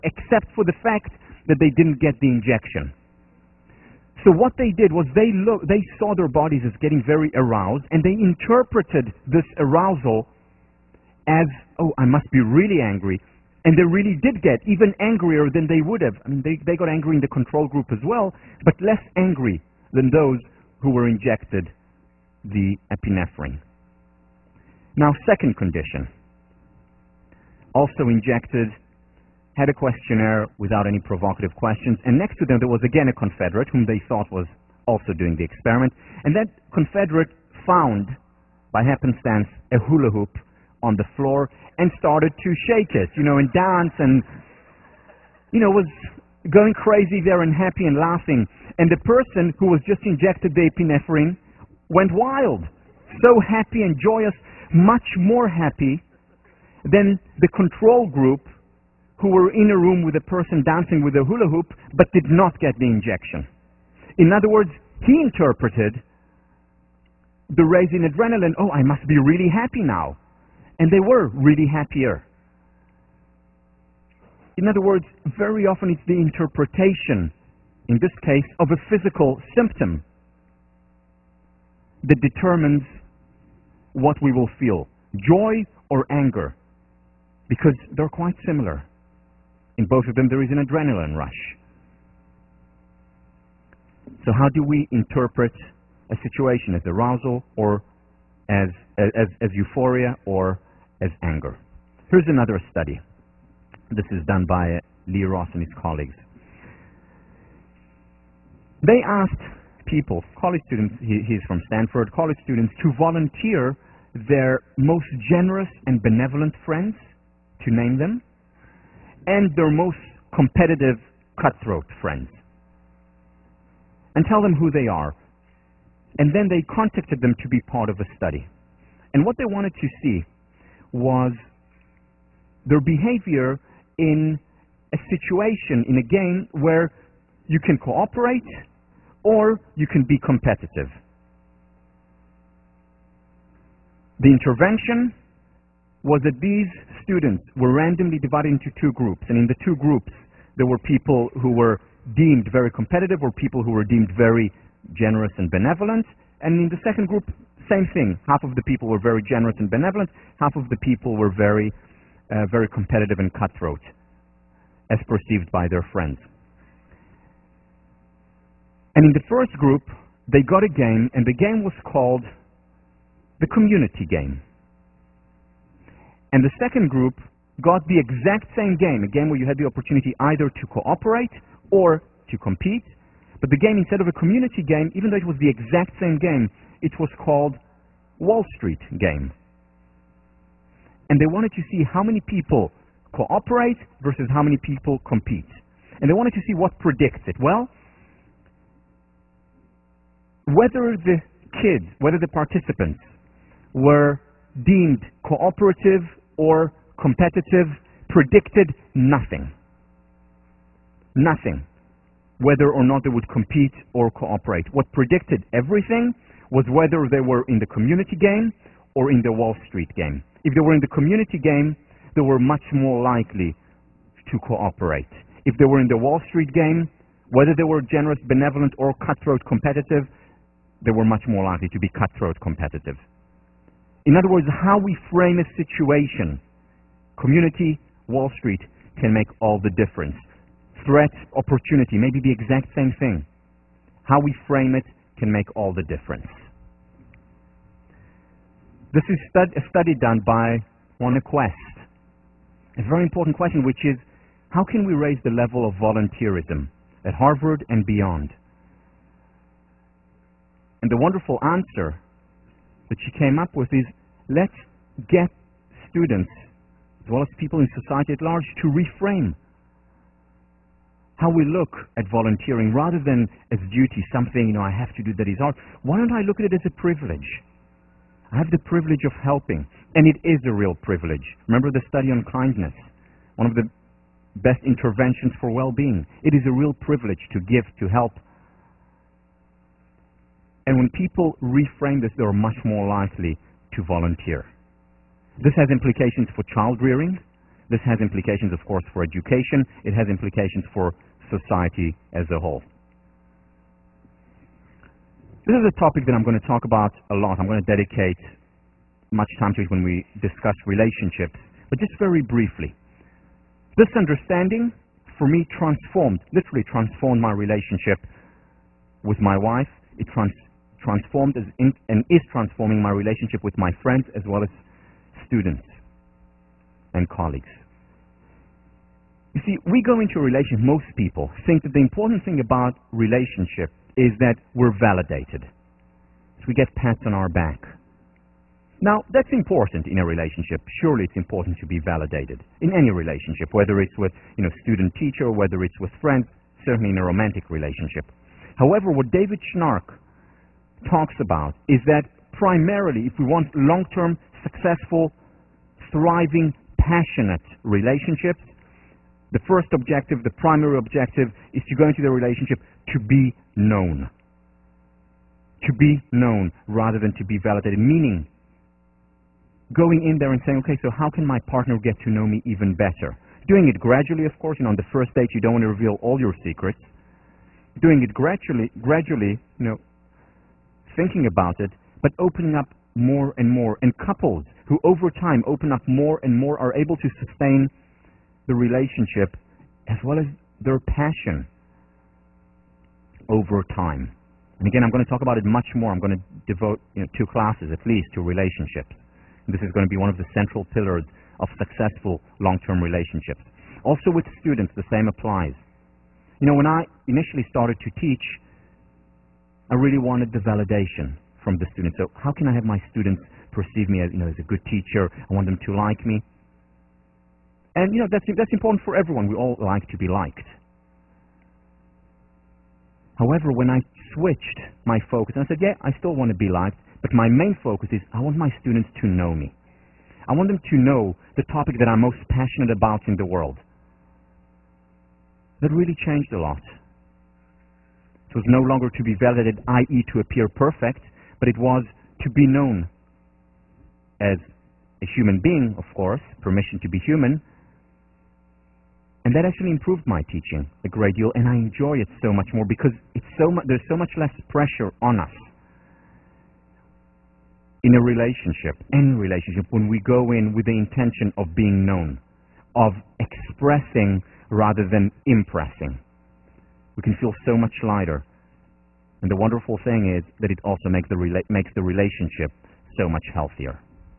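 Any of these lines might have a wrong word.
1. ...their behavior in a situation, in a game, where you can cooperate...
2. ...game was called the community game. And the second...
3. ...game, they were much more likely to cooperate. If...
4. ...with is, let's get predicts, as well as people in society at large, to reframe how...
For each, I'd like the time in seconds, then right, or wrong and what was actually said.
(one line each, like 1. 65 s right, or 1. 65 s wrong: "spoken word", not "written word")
1. 132 s right
2. 171 s right
3. 221 s right
4. 263 s wrong: "students", not "predicts".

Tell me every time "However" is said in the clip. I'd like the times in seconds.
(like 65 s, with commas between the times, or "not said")
348 s, 423 s.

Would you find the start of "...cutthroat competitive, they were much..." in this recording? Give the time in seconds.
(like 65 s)
228 s.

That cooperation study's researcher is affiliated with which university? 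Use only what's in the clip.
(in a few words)
Stanford.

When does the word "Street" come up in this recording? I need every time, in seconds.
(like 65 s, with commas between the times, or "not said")
188 s, 219 s, 226 s, 238 s.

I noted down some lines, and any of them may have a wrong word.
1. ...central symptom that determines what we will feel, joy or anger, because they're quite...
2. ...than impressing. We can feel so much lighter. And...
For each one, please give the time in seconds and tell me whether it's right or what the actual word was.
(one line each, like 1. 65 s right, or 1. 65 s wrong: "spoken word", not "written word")
1. 78 s wrong: "physical", not "central"
2. 464 s right.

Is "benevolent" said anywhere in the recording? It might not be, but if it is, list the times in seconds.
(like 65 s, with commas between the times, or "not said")
116 s, 155 s, 159 s, 228 s.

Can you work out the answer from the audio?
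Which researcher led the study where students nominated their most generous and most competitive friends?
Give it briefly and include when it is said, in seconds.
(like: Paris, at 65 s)
Lee Ross, at 105 s.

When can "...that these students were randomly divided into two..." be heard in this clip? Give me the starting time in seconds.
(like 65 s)
146 s.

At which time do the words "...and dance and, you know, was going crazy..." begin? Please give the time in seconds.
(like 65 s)
43 s.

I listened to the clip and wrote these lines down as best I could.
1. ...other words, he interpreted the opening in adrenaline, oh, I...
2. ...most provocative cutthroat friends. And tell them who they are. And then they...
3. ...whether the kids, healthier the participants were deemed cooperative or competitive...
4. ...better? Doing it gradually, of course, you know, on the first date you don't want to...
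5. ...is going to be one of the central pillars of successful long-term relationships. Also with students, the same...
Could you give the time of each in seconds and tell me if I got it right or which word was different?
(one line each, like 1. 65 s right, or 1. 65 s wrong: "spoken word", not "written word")
1. 64 s wrong: "raising", not "opening"
2. 119 s wrong: "competitive", not "provocative"
3. 200 s wrong: "whether", not "healthier"
4. 372 s right
5. 399 s right.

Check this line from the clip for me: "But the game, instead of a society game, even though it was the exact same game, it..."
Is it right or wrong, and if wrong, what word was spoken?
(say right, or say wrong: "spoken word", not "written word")
wrong: "community", not "society".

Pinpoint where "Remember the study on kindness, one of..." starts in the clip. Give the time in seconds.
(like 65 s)
281 s.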